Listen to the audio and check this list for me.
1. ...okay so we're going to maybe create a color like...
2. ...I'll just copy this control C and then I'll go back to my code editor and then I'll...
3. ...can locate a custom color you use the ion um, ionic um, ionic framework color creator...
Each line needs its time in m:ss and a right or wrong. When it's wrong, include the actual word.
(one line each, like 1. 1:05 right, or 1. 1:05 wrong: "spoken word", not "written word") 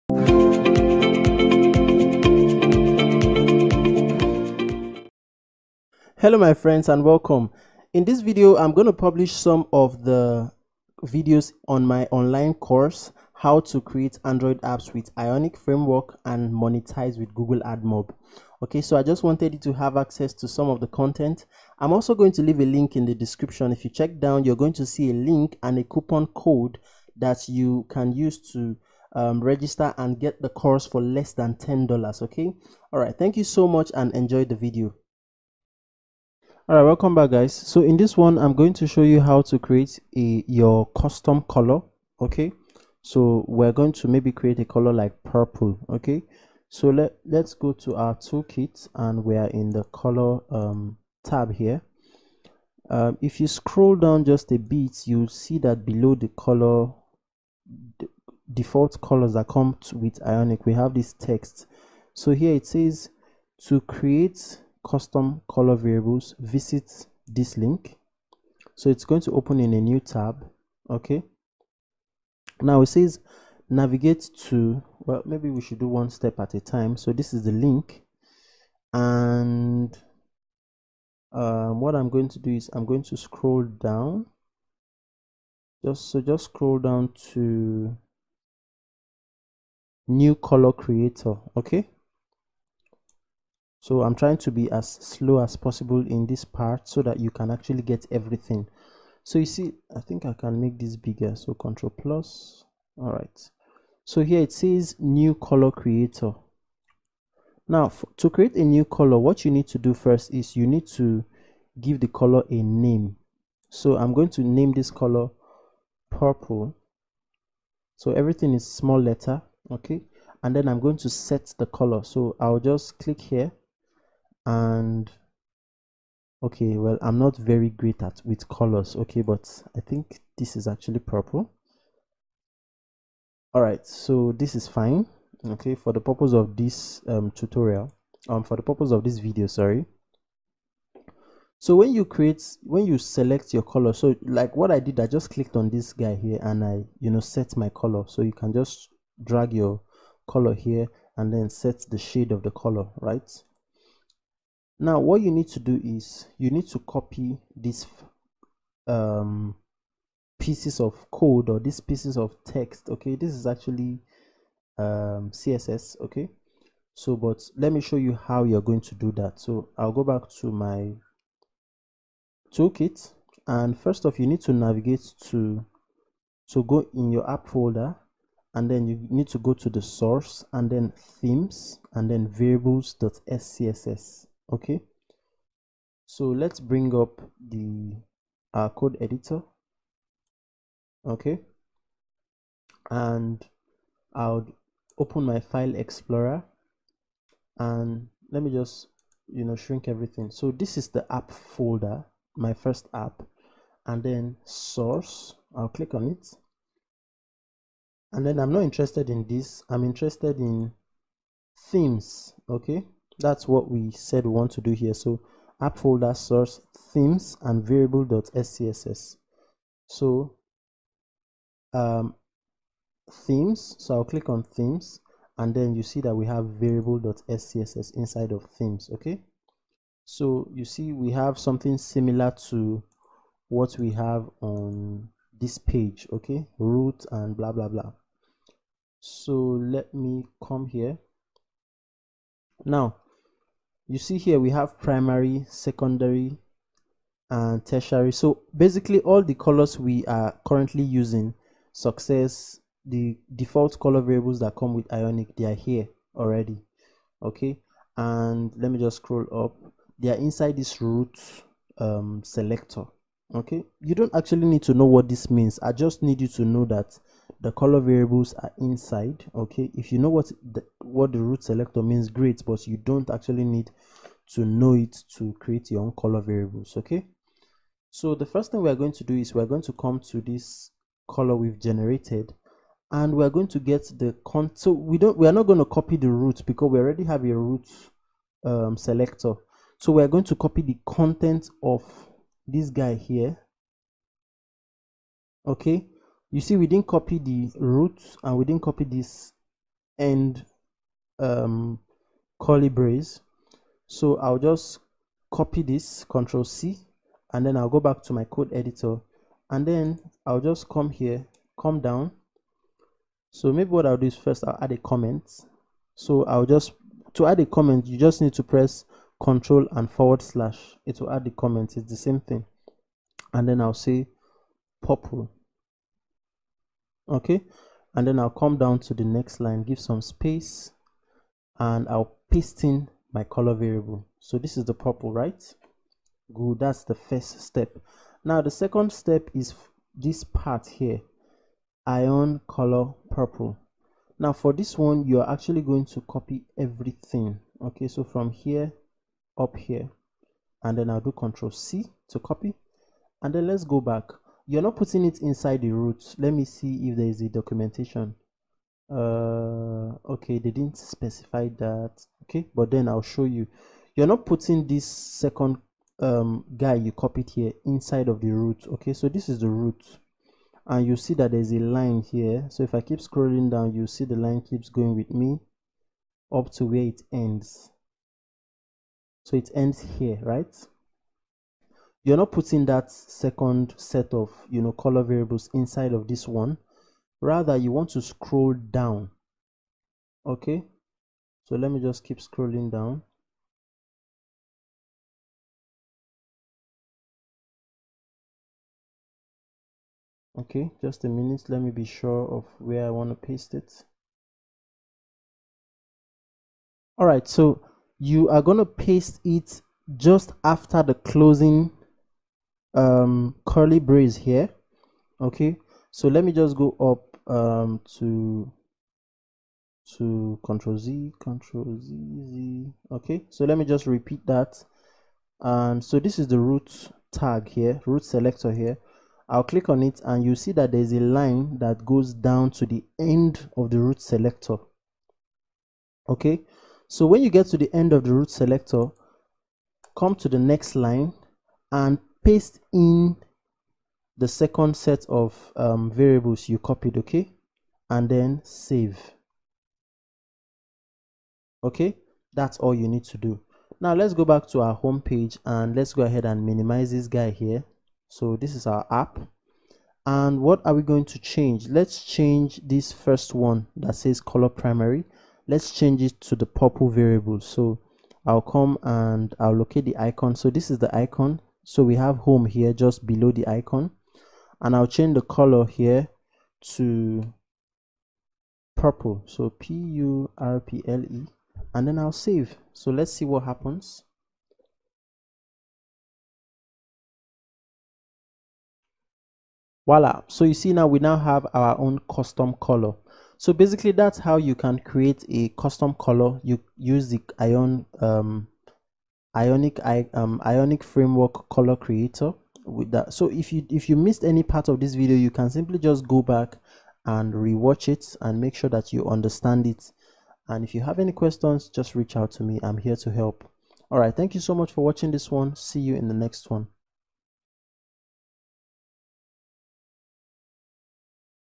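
1. 0:42 right
2. 5:04 right
3. 8:14 wrong: "create", not "locate".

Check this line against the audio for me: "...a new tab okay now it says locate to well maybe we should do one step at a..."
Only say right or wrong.
wrong.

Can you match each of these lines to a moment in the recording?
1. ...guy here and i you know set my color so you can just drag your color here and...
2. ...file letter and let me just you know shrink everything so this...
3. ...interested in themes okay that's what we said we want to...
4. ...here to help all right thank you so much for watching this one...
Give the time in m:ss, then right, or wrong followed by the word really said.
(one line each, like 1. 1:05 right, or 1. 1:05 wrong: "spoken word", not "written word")
1. 2:25 right
2. 3:15 wrong: "explorer", not "letter"
3. 3:29 right
4. 8:32 right.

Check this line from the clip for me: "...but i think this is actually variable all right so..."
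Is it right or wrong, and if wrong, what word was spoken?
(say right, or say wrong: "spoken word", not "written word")
wrong: "purple", not "variable".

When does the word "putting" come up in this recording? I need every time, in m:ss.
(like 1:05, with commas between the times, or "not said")
5:54, 6:04, 6:22.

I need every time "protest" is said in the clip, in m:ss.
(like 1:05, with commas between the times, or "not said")
not said.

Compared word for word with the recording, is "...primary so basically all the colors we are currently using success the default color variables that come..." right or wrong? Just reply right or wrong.
wrong.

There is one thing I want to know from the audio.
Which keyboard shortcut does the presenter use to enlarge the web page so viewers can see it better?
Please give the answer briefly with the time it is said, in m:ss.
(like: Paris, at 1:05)
Control plus, at 1:41.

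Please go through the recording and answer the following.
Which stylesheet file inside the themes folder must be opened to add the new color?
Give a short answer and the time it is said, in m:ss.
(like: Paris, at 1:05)
variables.scss, at 3:02.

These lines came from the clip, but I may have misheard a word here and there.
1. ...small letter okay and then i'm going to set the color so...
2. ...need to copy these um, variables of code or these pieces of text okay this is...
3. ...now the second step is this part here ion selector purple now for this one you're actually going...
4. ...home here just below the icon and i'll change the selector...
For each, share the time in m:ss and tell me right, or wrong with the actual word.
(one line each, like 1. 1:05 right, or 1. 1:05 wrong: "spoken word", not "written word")
1. 1:58 right
2. 2:36 wrong: "pieces", not "variables"
3. 5:38 wrong: "color", not "selector"
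4. 7:52 wrong: "color", not "selector".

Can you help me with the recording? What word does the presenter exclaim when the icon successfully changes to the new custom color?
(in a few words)
voila.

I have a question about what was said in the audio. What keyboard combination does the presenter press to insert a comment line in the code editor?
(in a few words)
Control and forward slash.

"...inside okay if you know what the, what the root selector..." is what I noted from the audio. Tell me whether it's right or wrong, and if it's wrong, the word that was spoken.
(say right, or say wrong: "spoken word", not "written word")
right.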